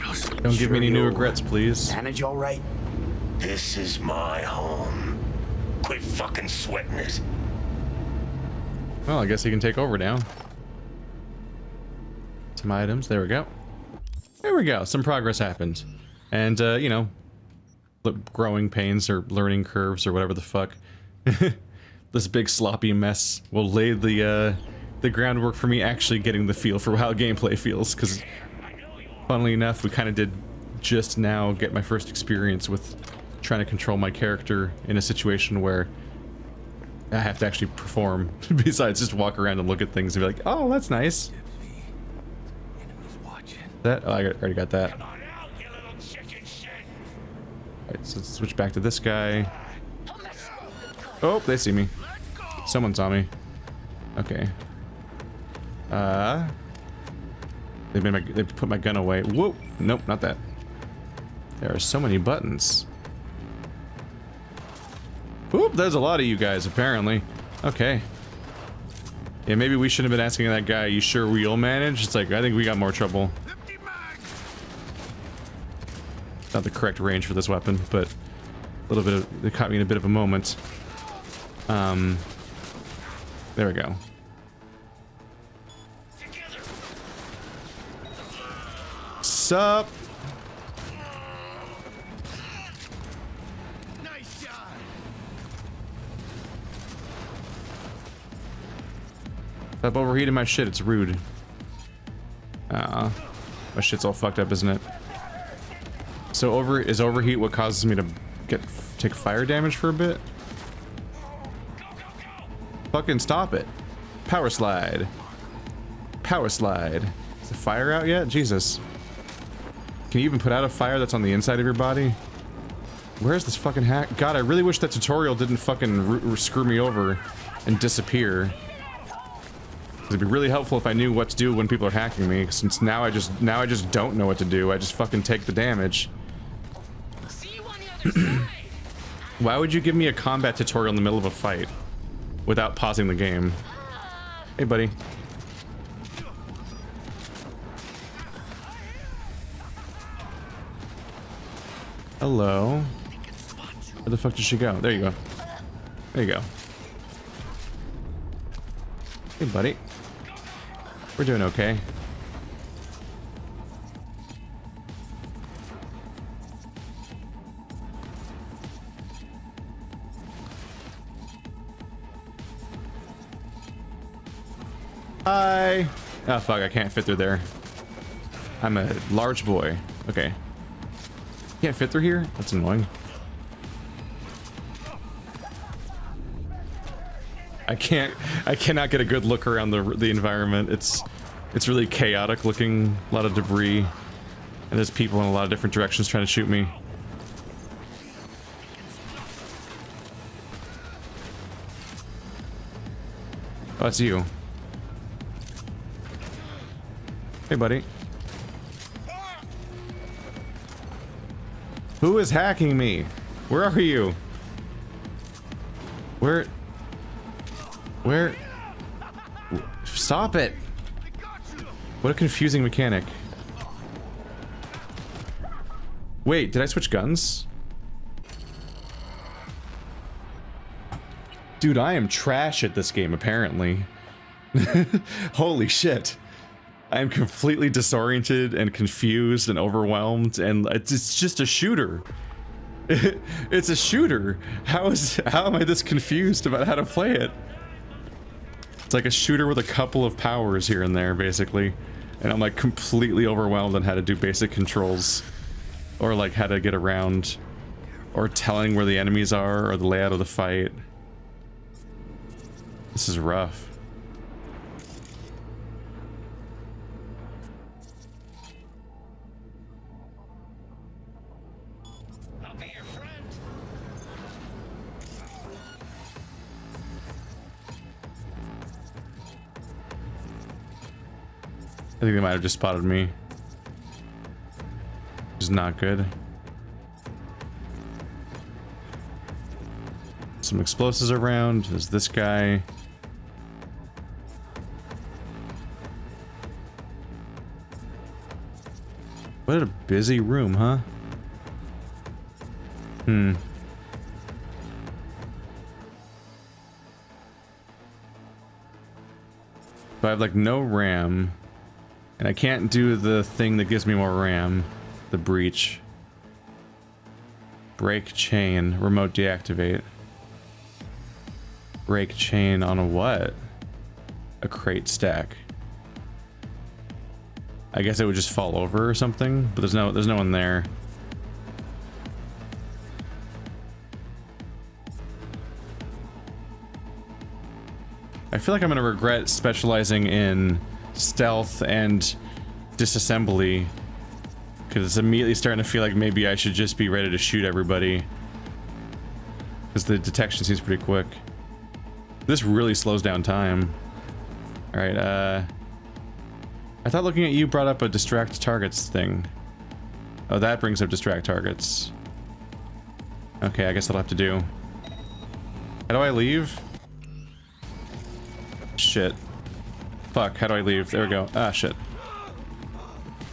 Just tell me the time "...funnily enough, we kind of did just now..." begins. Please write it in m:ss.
0:29.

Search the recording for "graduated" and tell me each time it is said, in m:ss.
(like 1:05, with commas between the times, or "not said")
not said.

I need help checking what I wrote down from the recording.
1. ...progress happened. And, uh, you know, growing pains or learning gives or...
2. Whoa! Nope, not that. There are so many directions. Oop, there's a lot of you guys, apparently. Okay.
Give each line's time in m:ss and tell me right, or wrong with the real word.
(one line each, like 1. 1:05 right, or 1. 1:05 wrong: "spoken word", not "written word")
1. 0:15 wrong: "curves", not "gives"
2. 0:59 wrong: "buttons", not "directions".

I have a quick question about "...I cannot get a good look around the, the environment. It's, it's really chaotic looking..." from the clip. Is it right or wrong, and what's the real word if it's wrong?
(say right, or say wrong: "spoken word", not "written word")
right.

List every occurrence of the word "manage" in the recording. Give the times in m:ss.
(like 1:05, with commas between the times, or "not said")
0:01, 1:11.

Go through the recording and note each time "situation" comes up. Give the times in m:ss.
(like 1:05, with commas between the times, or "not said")
0:35.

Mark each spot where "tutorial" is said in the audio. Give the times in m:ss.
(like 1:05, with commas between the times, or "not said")
2:04, 2:20.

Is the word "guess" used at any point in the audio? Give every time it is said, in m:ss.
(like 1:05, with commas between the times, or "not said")
0:09, 5:27, 6:03.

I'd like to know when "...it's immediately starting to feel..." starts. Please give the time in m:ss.
5:44.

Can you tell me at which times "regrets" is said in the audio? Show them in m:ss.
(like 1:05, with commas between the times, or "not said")
0:01, 5:38.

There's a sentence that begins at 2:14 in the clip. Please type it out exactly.
I just fucking take the damage.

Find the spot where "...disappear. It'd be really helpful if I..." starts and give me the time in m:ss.
2:07.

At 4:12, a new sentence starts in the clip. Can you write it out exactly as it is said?
And I'm like completely overwhelmed on how to do basic controls.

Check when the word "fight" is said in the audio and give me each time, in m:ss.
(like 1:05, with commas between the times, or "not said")
2:21, 4:20.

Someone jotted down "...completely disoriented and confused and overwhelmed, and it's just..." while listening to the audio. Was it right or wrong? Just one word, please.
right.